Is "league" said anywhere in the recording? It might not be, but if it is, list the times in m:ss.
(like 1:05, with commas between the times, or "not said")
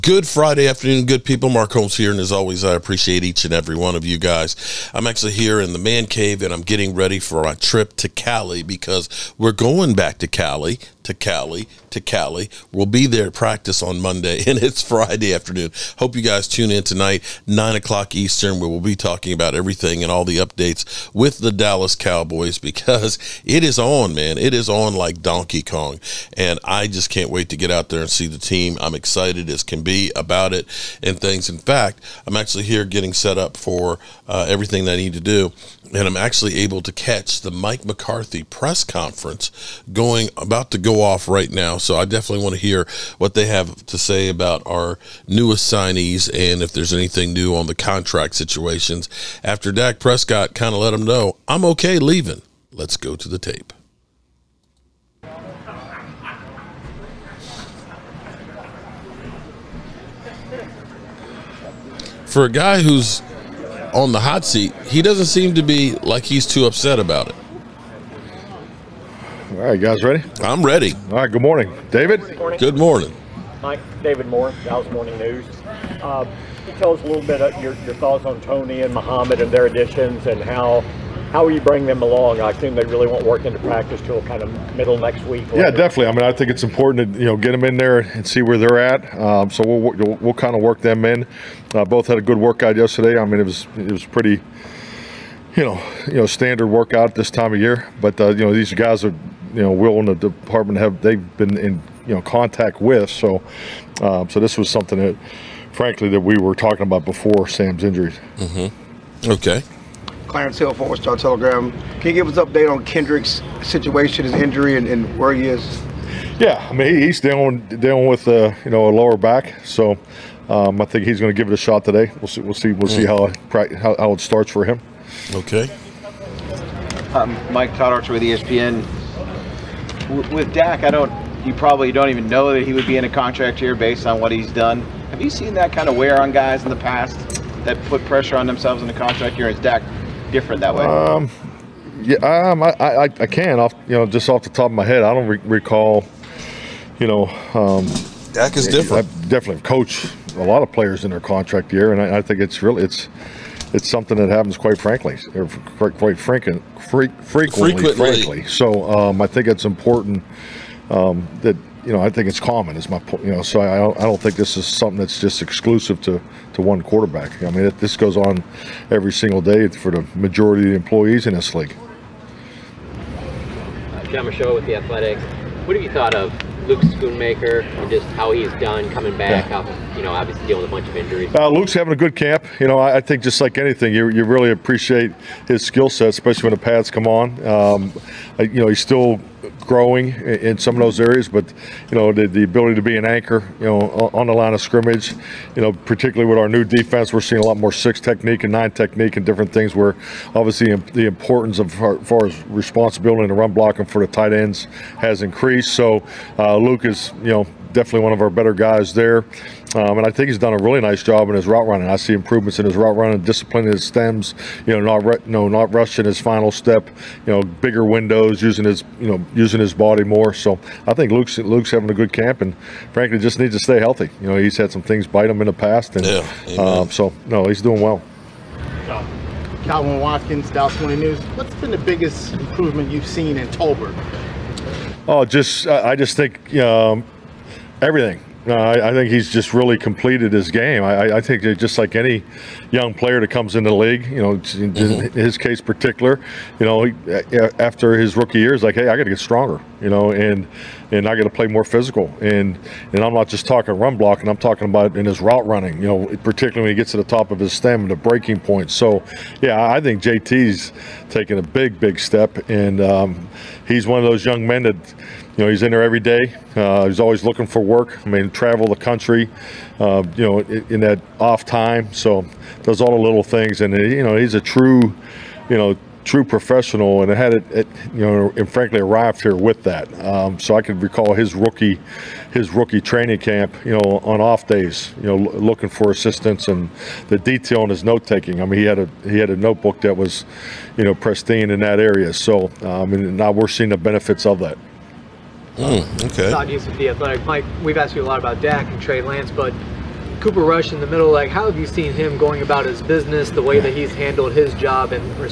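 2:51, 4:03.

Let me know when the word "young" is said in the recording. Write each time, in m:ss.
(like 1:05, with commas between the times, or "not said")
4:02, 4:24.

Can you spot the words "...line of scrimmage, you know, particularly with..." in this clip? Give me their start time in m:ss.
3:14.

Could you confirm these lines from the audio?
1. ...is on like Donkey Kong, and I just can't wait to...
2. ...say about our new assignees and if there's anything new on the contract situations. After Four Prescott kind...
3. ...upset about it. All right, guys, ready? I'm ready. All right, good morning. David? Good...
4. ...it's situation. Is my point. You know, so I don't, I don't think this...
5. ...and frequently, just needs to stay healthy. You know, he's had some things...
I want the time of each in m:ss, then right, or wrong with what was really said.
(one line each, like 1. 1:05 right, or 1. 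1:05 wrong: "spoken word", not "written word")
1. 0:24 right
2. 0:43 wrong: "Dak", not "Four"
3. 1:06 right
4. 2:42 wrong: "common", not "situation"
5. 3:42 wrong: "frankly", not "frequently".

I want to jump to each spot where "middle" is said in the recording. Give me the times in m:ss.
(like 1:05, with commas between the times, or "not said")
1:24, 5:00.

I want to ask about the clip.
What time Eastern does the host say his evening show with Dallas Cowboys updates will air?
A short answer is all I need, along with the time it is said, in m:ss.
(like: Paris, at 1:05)
9 o'clock, at 0:17.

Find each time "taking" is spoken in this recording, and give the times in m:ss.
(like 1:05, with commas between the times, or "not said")
4:21, 4:48.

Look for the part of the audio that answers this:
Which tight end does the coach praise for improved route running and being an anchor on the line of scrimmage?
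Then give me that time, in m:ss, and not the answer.
2:56.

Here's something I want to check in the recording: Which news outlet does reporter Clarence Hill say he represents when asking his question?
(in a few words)
Four Star Telegram.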